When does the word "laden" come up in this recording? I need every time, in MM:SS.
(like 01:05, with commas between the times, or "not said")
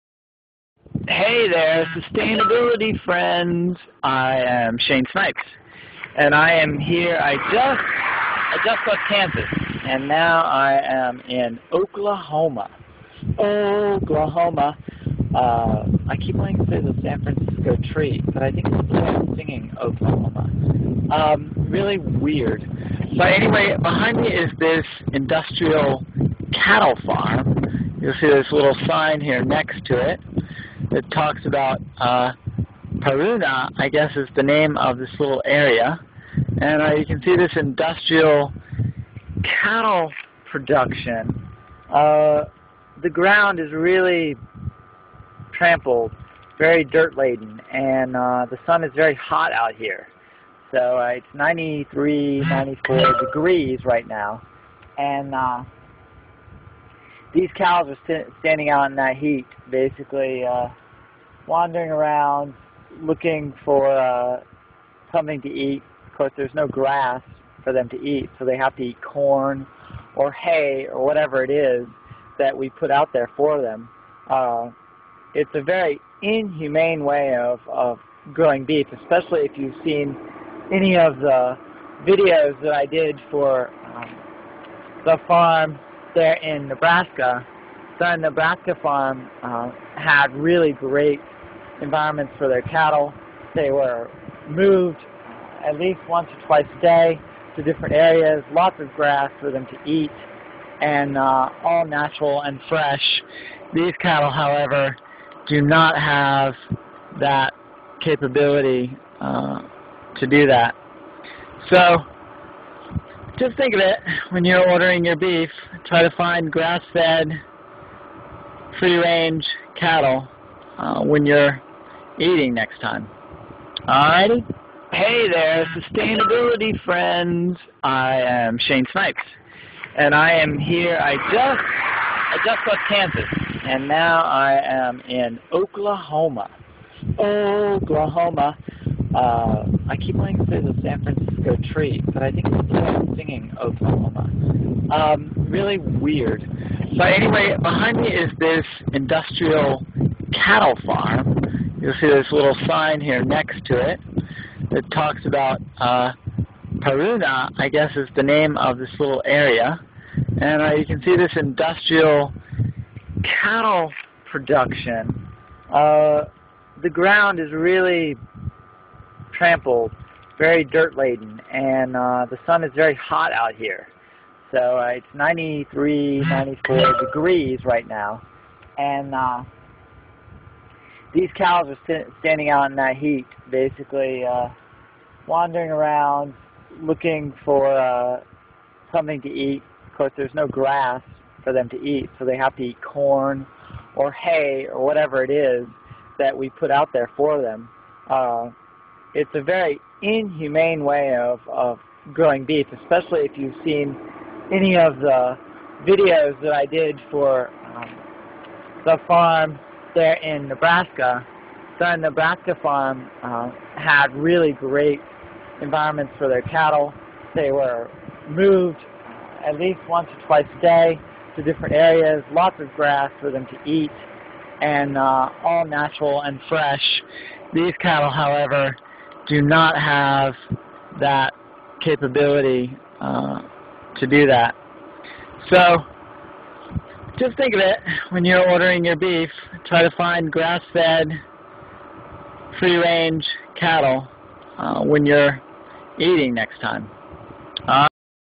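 00:47, 02:50.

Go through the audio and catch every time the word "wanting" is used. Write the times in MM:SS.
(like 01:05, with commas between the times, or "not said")
00:16, 02:20.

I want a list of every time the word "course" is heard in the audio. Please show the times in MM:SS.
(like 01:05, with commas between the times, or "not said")
01:06, 03:09.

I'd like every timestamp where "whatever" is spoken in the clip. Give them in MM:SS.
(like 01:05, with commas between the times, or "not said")
01:11, 03:14.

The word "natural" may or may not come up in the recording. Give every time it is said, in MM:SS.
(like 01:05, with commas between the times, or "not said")
01:41, 03:45.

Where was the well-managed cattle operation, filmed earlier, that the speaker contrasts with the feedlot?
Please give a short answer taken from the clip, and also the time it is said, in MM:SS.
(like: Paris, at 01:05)
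Southern Nebraska, at 03:31.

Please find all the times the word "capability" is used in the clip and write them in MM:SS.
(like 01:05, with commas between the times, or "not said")
01:48, 03:51.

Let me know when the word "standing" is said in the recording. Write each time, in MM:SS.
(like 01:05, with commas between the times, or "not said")
00:58, 03:02.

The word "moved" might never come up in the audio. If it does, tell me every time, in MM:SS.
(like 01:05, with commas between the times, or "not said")
01:34, 03:38.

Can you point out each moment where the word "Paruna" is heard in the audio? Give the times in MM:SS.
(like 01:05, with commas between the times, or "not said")
00:32, 02:36.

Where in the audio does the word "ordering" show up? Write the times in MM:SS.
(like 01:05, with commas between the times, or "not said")
01:54, 03:58.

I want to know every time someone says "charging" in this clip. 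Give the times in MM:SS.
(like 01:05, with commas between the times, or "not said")
not said.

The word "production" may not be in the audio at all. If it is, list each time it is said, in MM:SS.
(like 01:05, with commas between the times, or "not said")
00:40, 02:44.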